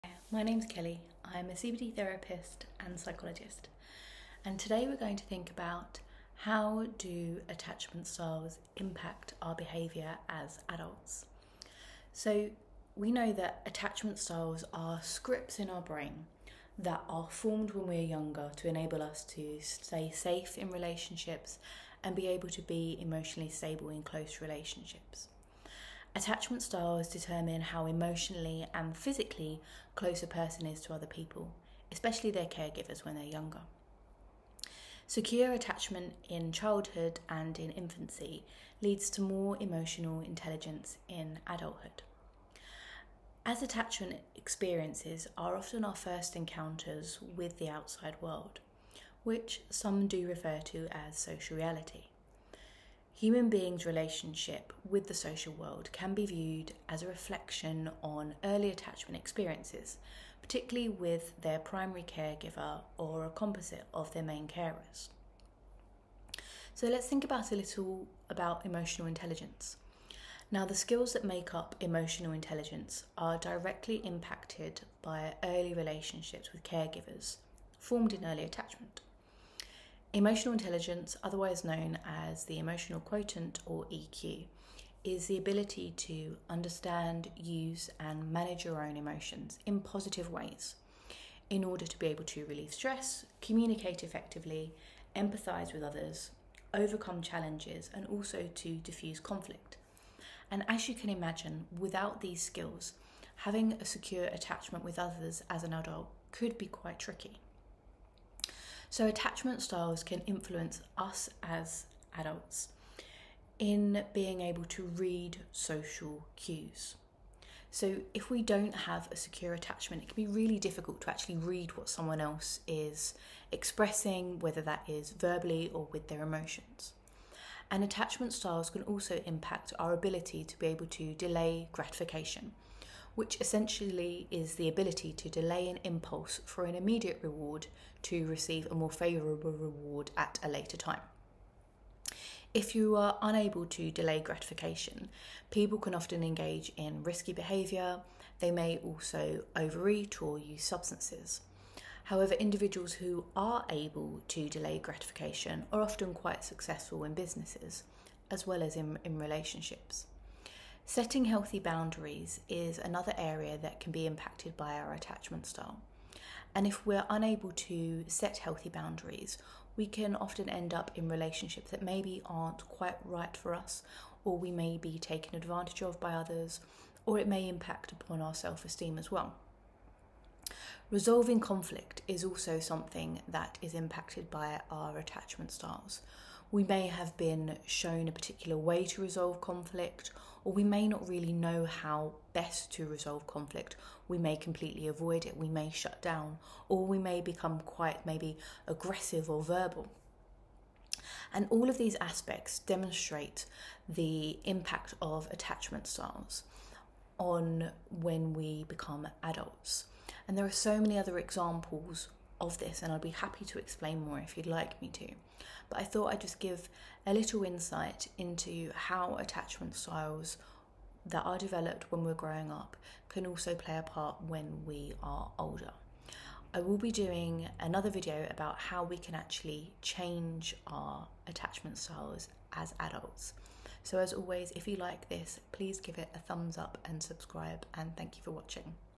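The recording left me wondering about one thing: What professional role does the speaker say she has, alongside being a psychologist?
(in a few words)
CBT therapist.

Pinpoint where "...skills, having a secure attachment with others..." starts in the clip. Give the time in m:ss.
1:42.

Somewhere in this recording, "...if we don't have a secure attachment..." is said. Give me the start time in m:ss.
1:58.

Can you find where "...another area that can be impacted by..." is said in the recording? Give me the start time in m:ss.
2:42.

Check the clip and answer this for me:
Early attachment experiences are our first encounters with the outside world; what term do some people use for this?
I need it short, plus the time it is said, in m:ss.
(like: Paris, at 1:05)
social reality, at 0:51.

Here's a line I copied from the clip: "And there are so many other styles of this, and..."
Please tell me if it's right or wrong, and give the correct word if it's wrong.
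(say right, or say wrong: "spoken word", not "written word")
wrong: "examples", not "styles".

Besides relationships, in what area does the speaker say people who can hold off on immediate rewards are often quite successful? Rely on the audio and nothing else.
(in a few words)
businesses.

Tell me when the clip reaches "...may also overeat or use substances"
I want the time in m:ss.
2:28.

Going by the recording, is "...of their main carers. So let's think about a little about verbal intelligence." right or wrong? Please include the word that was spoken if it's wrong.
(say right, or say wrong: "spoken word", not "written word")
wrong: "emotional", not "verbal".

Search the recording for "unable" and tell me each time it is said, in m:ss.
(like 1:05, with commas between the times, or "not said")
2:23, 2:47.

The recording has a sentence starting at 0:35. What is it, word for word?
Secure attachment in childhood and in infancy leads to more emotional intelligence in adulthood.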